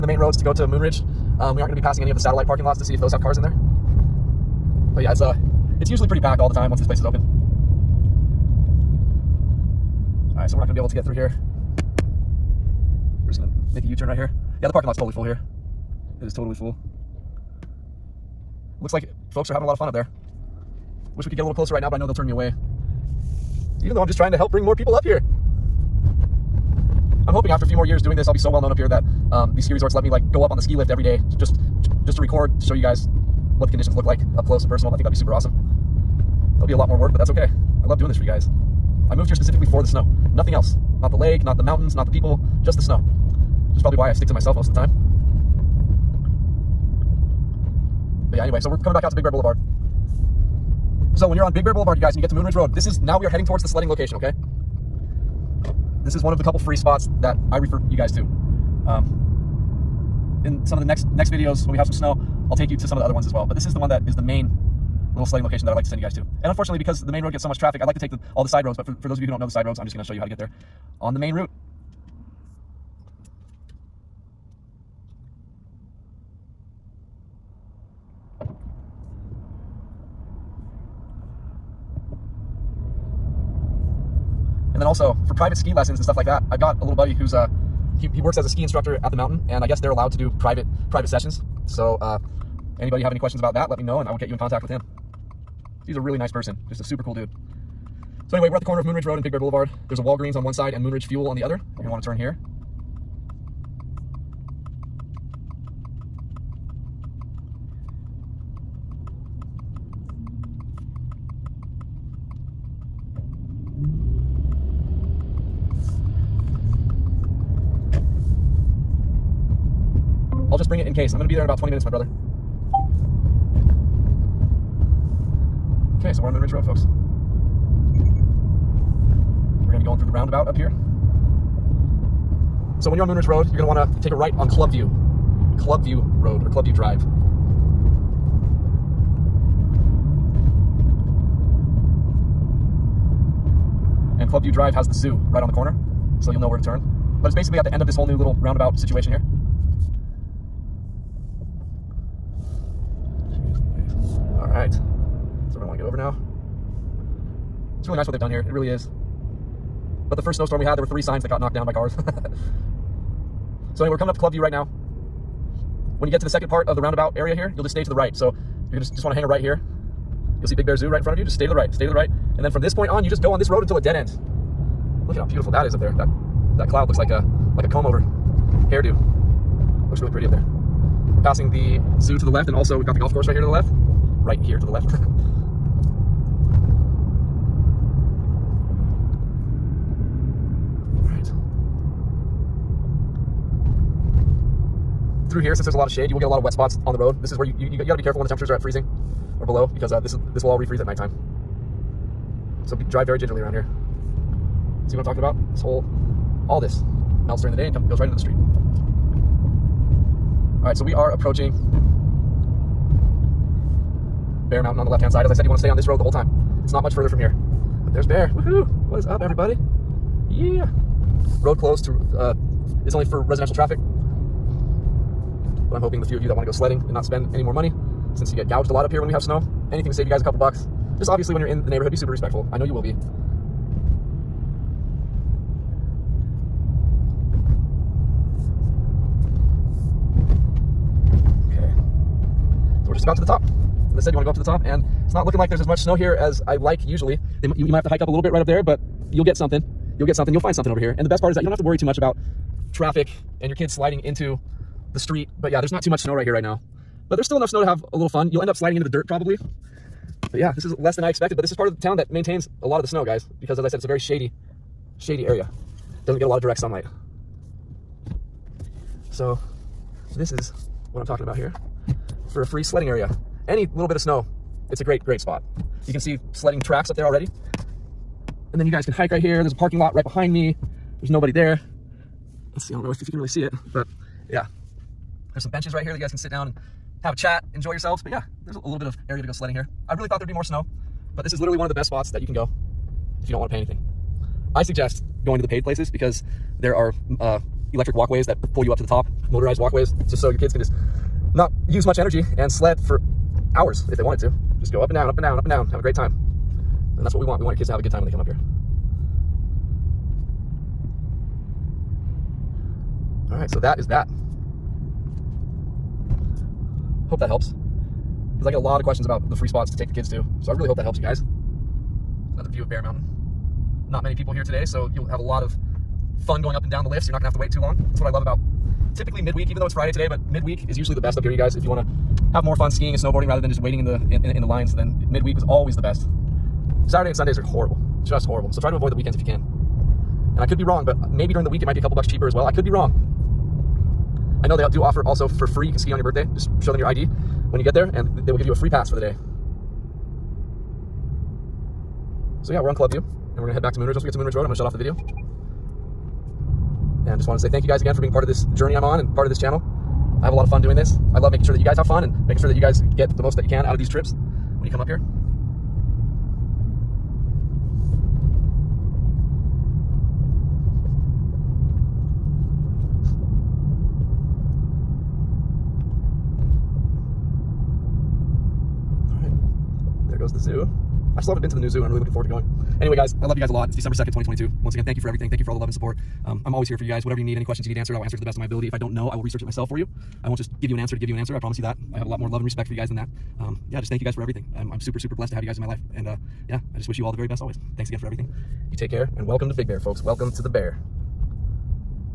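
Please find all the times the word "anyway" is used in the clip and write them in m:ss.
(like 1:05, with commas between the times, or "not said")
0:48, 1:38, 2:43, 6:22.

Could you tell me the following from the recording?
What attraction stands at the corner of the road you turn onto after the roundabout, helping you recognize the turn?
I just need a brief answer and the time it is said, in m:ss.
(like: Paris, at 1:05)
Big Bear Zoo, at 2:50.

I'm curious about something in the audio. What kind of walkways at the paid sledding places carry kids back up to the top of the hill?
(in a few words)
electric walkways.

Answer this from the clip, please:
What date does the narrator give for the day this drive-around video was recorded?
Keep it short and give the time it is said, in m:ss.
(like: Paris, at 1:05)
December 2, 2022, at 6:23.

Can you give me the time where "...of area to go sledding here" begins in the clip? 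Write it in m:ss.
4:48.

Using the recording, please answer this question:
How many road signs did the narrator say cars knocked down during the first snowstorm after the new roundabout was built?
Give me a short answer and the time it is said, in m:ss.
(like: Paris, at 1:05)
3, at 2:40.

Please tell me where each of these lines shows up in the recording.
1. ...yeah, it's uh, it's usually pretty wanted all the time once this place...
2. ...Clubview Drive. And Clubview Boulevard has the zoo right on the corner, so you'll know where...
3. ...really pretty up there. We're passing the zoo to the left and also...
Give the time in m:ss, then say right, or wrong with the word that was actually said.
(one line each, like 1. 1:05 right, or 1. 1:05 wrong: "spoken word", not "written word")
1. 0:05 wrong: "packed", not "wanted"
2. 2:16 wrong: "Drive", not "Boulevard"
3. 2:59 right.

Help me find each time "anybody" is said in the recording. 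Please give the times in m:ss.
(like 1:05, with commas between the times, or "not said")
1:32.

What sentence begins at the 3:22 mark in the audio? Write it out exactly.
So be, drive very gingerly around here.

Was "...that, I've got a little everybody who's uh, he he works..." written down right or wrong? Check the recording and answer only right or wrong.
wrong.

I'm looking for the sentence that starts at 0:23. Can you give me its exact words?
Even though I'm just trying to help bring more people up here.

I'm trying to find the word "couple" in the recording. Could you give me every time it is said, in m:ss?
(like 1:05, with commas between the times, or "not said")
0:56, 3:50, 5:41.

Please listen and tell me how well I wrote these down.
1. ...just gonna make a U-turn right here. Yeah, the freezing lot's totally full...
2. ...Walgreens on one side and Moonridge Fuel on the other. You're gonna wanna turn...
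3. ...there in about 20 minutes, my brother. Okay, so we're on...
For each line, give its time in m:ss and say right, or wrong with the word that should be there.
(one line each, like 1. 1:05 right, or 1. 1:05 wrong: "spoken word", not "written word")
1. 0:13 wrong: "parking", not "freezing"
2. 1:40 right
3. 2:01 right.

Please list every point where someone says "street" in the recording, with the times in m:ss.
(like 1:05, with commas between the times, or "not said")
3:28, 4:14.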